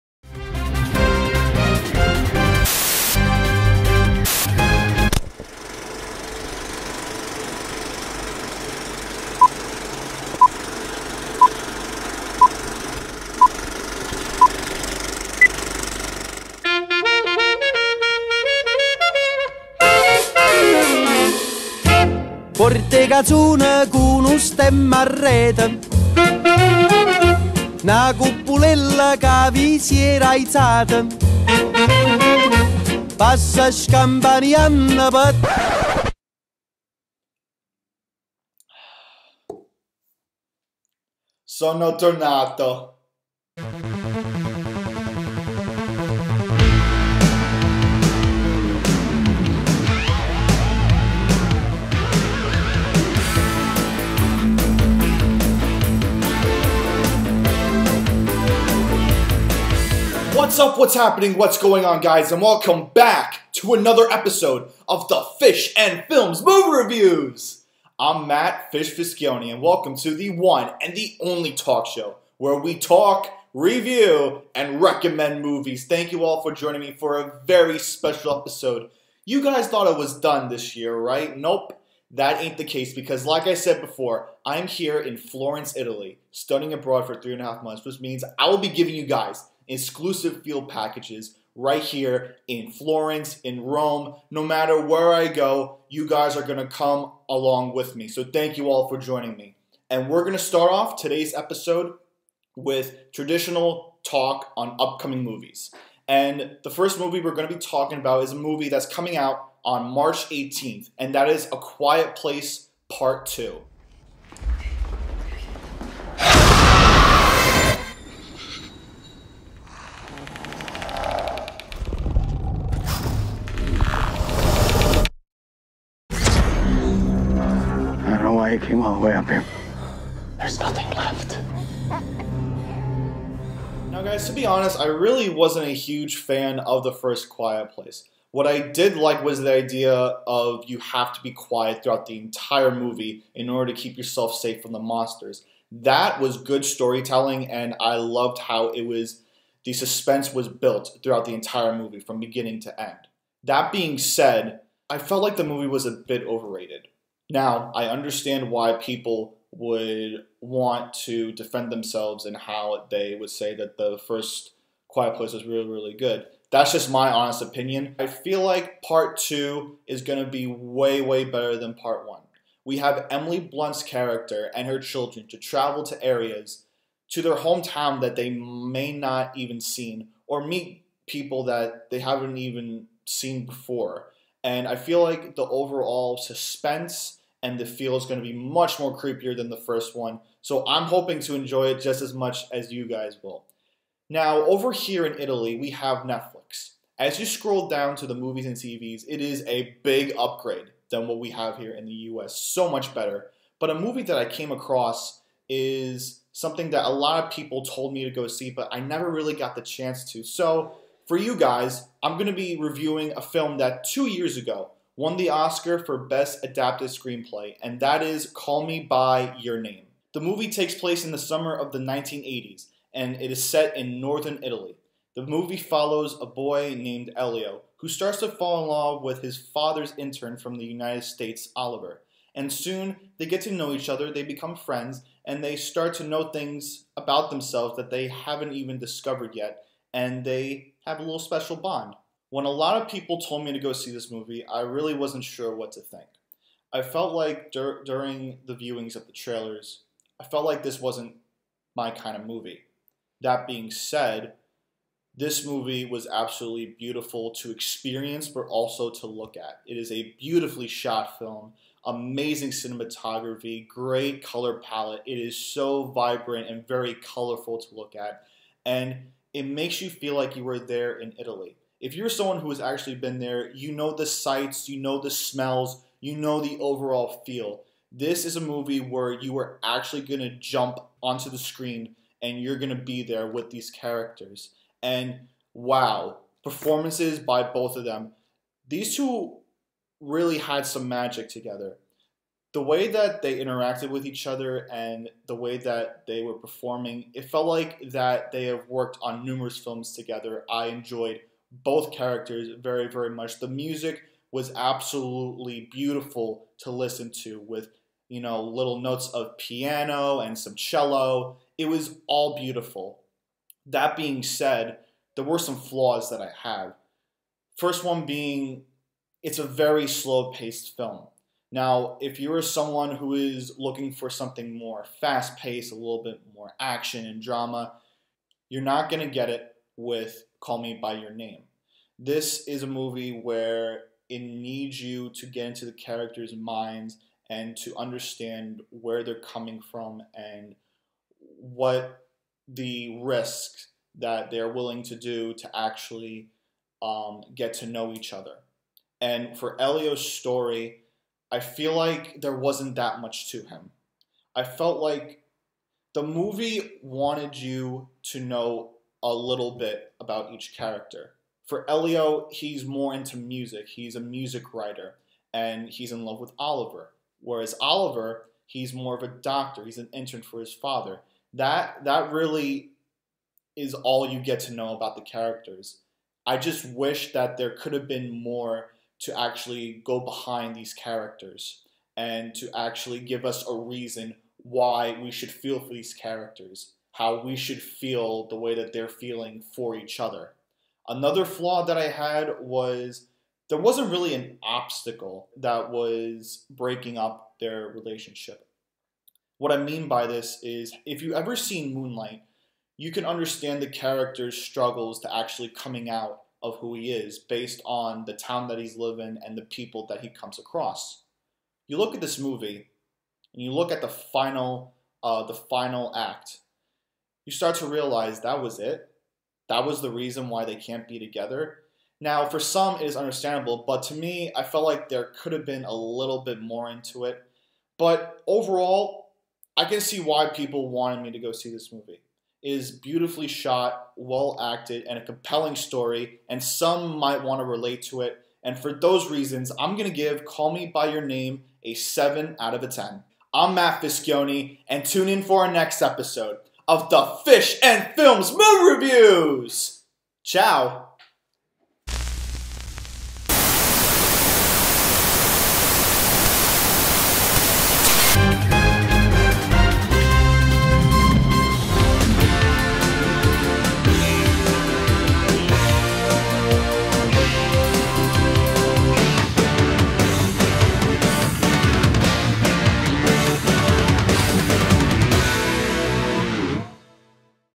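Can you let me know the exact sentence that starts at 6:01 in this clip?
For Elio, he's more into music.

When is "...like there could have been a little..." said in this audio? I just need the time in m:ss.
7:04.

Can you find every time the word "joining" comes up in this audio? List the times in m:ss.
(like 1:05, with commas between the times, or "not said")
1:16, 1:38.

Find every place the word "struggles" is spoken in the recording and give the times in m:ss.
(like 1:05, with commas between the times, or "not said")
6:44.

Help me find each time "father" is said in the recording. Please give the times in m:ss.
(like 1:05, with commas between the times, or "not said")
3:49, 6:10.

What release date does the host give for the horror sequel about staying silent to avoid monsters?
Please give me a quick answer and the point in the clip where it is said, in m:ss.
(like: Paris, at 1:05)
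March 18th, at 1:49.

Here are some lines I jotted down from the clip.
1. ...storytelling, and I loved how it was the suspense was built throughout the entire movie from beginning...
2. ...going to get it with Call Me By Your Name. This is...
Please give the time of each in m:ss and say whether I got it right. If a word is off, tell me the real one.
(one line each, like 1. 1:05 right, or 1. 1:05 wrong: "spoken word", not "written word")
1. 2:26 right
2. 5:28 right.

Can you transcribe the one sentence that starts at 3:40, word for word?
The movie takes place in the summer of the 1980s, and it is set in northern Italy.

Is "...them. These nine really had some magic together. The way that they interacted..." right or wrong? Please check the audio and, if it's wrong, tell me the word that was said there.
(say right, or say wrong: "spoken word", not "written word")
wrong: "two", not "nine".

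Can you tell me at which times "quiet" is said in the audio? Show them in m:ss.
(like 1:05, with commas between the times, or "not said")
1:51, 2:17, 2:21, 2:44.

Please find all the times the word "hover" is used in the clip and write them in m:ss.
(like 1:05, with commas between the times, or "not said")
not said.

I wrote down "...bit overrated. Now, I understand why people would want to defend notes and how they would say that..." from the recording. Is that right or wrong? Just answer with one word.
wrong.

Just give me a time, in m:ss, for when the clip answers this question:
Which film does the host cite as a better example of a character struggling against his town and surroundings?
6:41.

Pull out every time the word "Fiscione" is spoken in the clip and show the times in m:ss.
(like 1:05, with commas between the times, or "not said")
1:08, 7:23.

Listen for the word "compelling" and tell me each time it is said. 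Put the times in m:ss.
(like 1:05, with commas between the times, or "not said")
7:15.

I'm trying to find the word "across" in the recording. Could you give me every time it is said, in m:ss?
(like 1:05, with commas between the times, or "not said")
3:24, 6:50.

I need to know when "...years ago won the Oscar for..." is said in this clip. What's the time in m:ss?
3:34.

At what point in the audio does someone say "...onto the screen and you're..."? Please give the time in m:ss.
4:41.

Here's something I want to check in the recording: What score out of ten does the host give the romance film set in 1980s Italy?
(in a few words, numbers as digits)
7.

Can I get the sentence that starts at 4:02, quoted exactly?
When a lot of people told me to go see this movie, I really wasn't sure what to think.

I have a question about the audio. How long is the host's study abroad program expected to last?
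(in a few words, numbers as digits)
3.5 months.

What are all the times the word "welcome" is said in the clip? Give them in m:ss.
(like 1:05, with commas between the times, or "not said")
1:02, 1:09.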